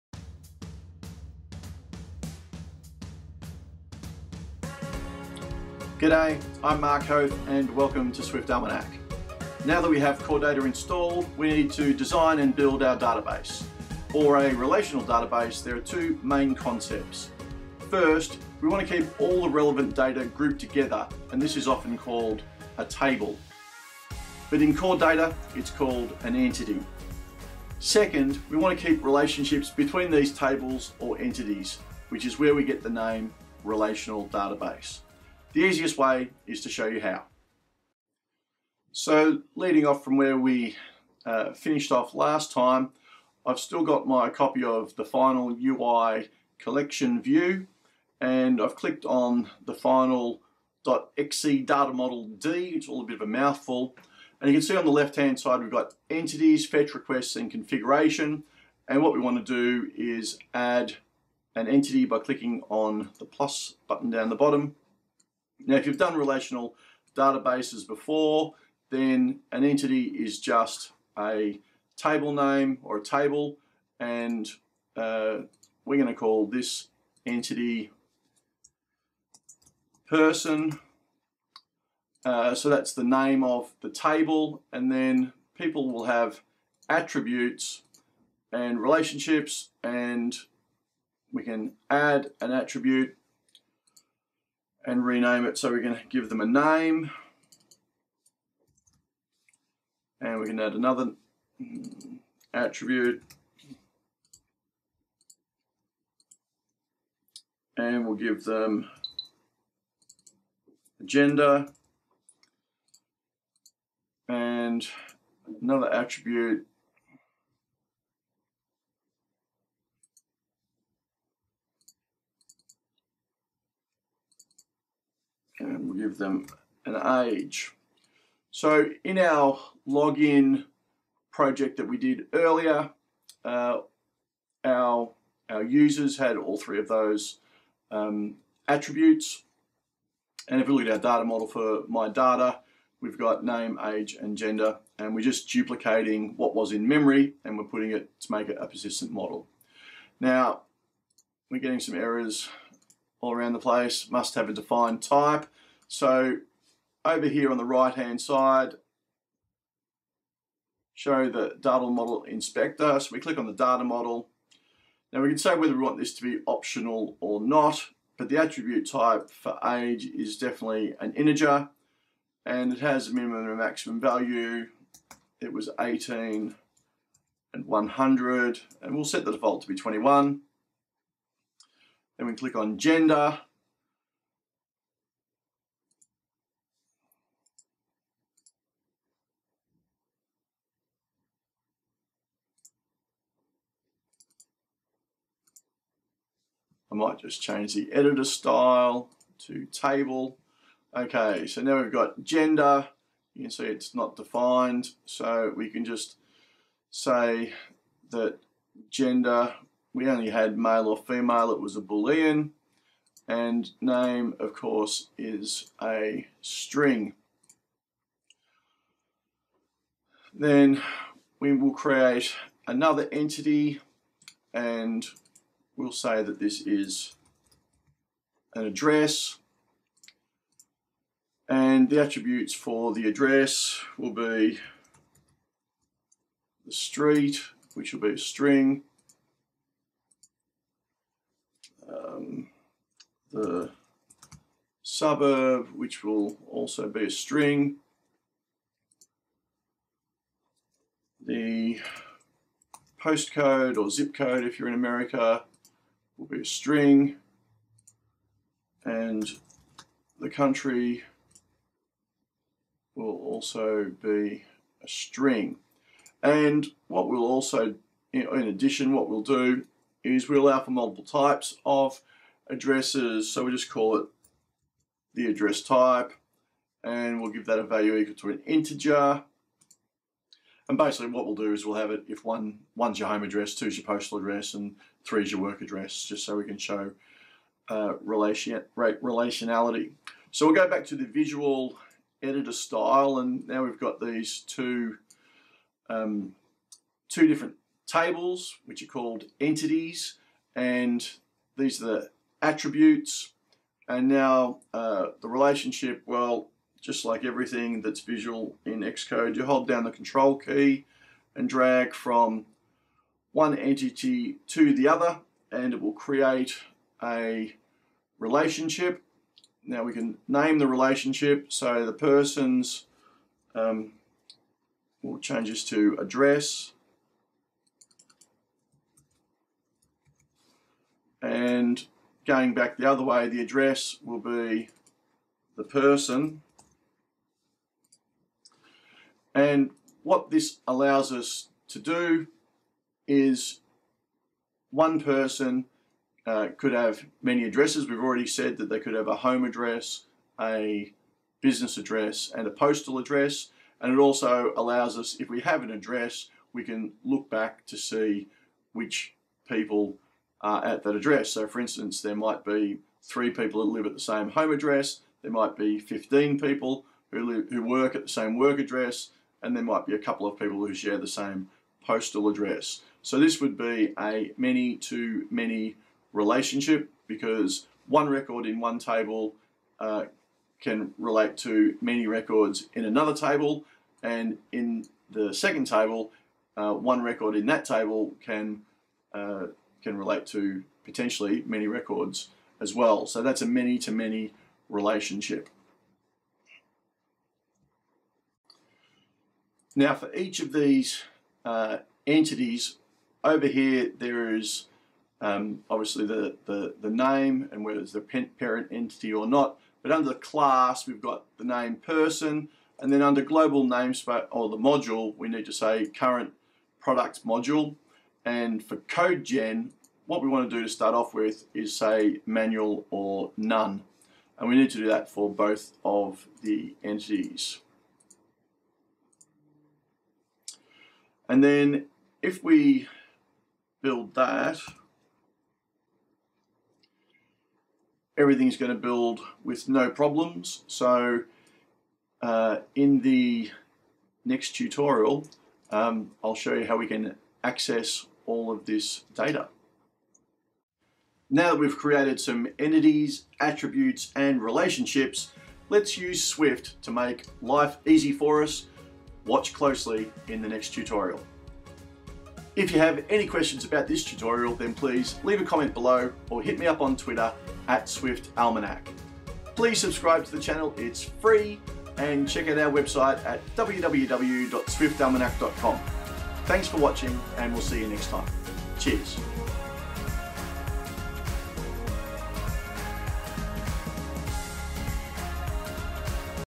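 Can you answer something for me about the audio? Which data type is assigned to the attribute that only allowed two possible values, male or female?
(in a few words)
Boolean.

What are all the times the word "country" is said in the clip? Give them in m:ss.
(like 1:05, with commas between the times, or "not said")
4:20.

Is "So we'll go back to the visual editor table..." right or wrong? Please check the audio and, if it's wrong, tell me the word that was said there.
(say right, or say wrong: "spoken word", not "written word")
wrong: "style", not "table".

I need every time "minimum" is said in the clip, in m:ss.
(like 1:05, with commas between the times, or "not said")
2:53.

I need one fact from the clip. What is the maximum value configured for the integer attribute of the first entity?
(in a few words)
100.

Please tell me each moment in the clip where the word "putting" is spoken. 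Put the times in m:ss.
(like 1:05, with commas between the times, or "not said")
2:27.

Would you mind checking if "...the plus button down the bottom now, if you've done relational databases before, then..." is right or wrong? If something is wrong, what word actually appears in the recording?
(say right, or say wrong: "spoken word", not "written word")
right.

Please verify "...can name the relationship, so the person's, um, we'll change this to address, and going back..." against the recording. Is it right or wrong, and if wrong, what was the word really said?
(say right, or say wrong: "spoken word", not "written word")
right.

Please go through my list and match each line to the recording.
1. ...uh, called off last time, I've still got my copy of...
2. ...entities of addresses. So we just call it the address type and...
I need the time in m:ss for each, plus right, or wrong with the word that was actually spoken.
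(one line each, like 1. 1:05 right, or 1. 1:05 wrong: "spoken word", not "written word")
1. 0:41 wrong: "finished", not "called"
2. 4:31 wrong: "types", not "entities".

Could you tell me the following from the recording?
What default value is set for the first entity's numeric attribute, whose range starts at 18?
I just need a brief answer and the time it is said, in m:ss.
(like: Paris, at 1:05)
21, at 2:59.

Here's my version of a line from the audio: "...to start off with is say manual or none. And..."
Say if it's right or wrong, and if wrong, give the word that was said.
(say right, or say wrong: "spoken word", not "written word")
right.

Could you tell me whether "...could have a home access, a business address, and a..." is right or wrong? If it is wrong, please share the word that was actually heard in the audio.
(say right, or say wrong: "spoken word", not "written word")
wrong: "address", not "access".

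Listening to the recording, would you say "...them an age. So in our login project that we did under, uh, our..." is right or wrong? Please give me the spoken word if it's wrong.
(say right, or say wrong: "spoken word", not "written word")
wrong: "earlier", not "under".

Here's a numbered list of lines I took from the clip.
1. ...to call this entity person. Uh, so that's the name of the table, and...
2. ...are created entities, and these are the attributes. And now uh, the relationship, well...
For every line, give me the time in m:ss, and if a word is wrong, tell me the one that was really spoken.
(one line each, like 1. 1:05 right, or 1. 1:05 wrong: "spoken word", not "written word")
1. 1:16 right
2. 4:58 wrong: "called", not "created".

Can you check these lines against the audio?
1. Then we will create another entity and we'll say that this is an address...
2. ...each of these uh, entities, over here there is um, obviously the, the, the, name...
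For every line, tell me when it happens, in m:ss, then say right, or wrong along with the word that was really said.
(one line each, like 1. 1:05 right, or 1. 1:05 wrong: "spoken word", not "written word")
1. 3:40 right
2. 6:40 right.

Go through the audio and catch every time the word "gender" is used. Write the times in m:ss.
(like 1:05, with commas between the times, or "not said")
1:51, 2:24, 3:02, 3:22, 3:28.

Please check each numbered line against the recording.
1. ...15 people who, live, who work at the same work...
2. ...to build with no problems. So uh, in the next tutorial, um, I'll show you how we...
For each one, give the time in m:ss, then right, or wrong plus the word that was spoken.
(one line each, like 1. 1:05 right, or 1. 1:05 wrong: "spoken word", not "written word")
1. 6:05 right
2. 7:18 right.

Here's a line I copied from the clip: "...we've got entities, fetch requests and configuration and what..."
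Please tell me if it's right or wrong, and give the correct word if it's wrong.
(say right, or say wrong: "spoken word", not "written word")
right.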